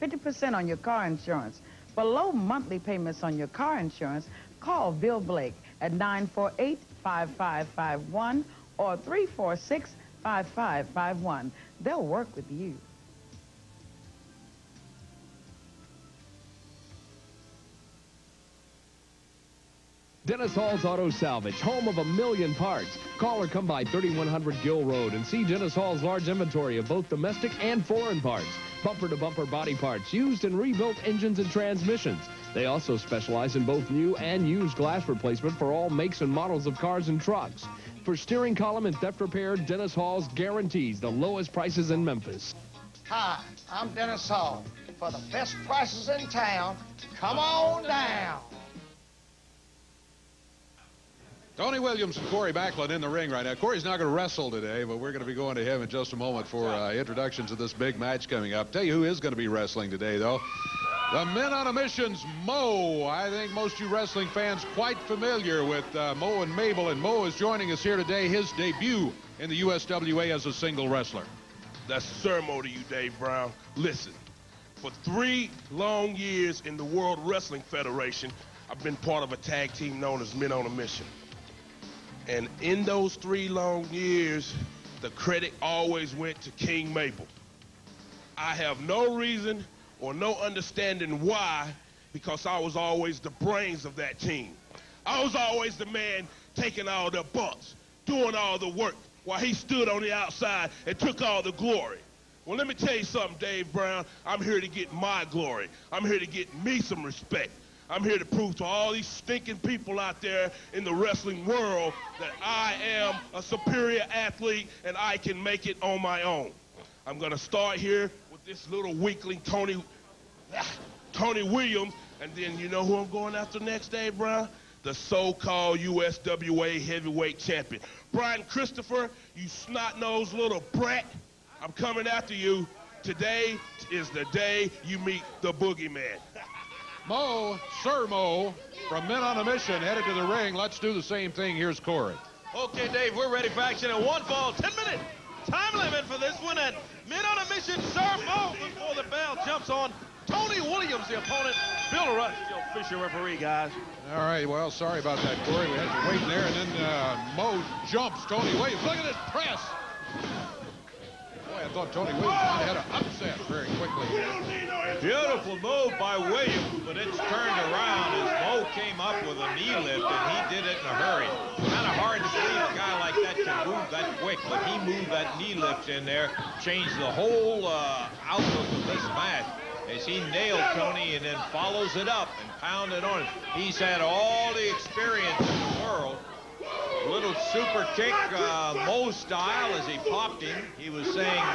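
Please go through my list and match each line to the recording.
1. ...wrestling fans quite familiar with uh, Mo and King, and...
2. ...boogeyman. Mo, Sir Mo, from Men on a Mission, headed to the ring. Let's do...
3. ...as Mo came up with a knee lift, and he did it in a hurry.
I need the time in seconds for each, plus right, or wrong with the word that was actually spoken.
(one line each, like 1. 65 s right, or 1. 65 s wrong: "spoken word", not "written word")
1. 63 s wrong: "Mabel", not "King"
2. 135 s right
3. 168 s right.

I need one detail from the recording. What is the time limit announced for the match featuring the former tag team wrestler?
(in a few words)
10 minutes.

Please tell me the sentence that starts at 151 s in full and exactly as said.
Bill Rush, still Fisher referee, guys.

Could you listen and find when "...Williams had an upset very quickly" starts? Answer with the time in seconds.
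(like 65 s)
162 s.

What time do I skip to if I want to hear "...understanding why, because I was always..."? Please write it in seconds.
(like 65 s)
90 s.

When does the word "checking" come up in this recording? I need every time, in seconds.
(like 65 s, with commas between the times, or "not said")
not said.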